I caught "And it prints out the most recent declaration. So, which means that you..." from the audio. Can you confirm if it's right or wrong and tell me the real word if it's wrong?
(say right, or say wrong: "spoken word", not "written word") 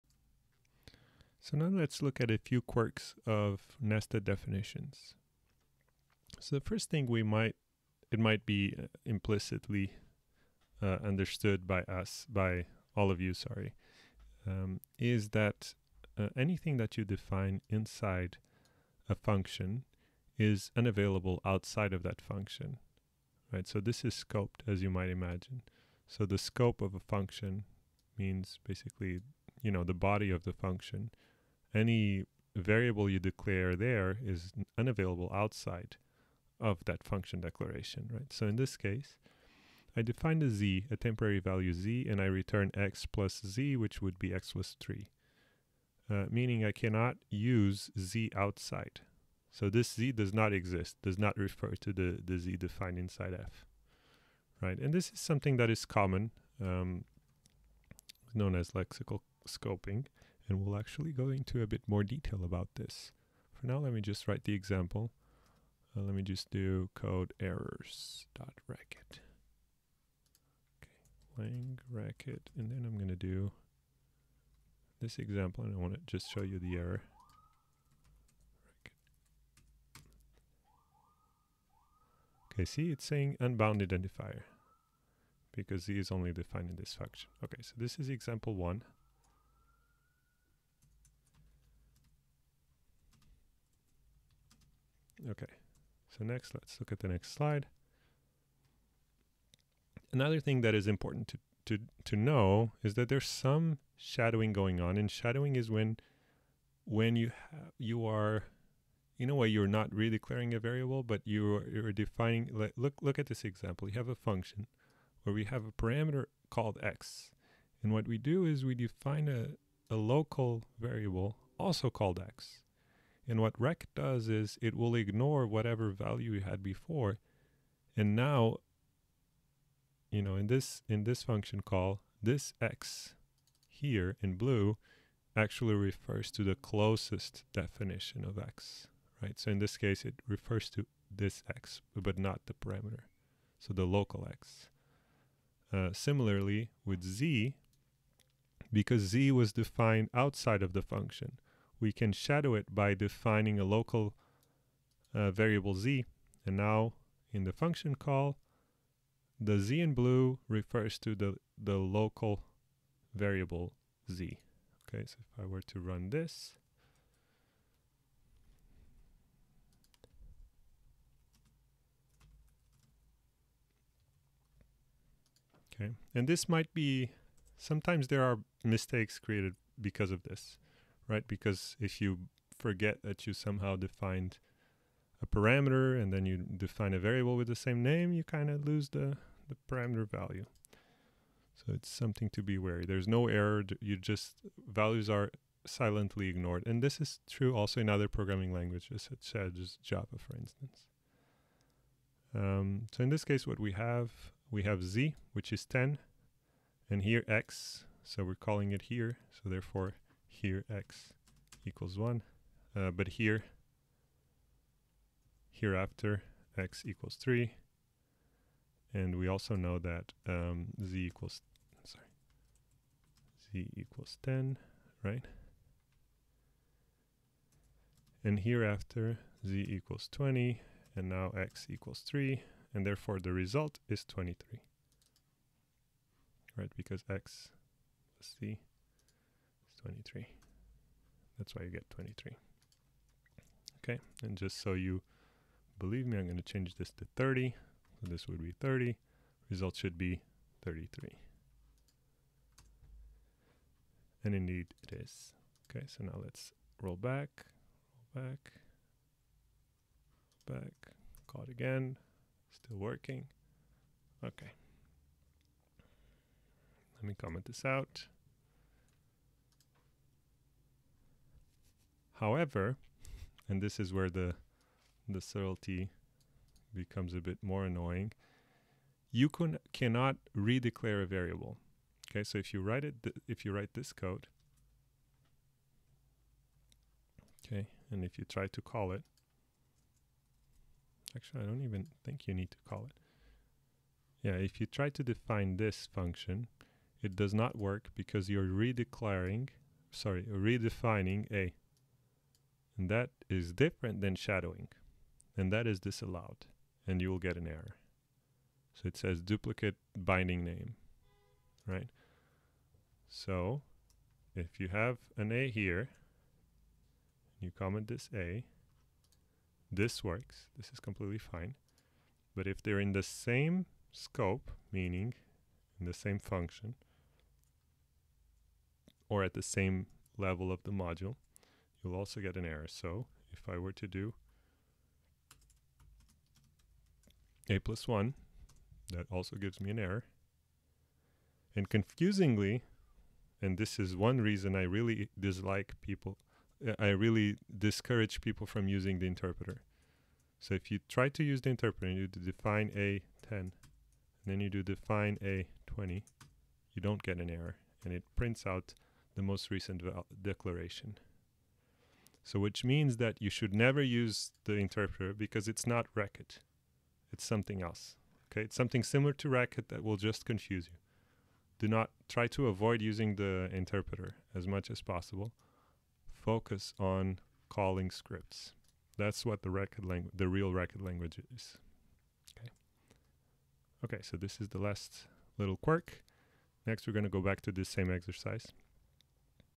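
right.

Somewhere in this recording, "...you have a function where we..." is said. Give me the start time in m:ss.
1:53.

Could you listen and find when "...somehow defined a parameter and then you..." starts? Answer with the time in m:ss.
3:03.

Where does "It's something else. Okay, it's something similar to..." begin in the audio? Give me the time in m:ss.
6:07.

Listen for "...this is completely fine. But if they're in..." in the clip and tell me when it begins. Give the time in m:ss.
5:20.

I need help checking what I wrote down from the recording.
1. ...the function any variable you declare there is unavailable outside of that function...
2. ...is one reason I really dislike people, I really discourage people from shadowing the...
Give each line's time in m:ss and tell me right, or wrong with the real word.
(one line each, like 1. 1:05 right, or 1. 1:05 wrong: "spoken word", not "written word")
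1. 0:30 right
2. 5:43 wrong: "using", not "shadowing".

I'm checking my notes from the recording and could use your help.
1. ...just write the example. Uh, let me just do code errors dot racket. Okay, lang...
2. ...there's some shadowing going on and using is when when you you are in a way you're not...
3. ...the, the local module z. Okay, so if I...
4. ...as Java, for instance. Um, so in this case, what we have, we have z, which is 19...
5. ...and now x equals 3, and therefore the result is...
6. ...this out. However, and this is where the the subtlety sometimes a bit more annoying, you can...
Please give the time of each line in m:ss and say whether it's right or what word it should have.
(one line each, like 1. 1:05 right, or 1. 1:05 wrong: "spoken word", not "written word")
1. 1:04 right
2. 1:43 wrong: "shadowing", not "using"
3. 2:41 wrong: "variable", not "module"
4. 3:19 wrong: "10", not "19"
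5. 3:50 right
6. 4:27 wrong: "becomes", not "sometimes".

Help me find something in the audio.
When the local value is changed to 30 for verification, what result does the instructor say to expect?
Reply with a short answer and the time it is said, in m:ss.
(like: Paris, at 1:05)
33, at 4:10.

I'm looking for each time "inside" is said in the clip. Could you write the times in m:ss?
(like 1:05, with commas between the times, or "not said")
0:17, 0:52.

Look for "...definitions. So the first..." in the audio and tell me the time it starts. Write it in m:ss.
0:04.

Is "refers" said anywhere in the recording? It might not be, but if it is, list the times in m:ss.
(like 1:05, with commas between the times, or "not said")
0:51, 2:15, 2:20, 2:40.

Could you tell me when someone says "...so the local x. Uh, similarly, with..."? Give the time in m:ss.
2:23.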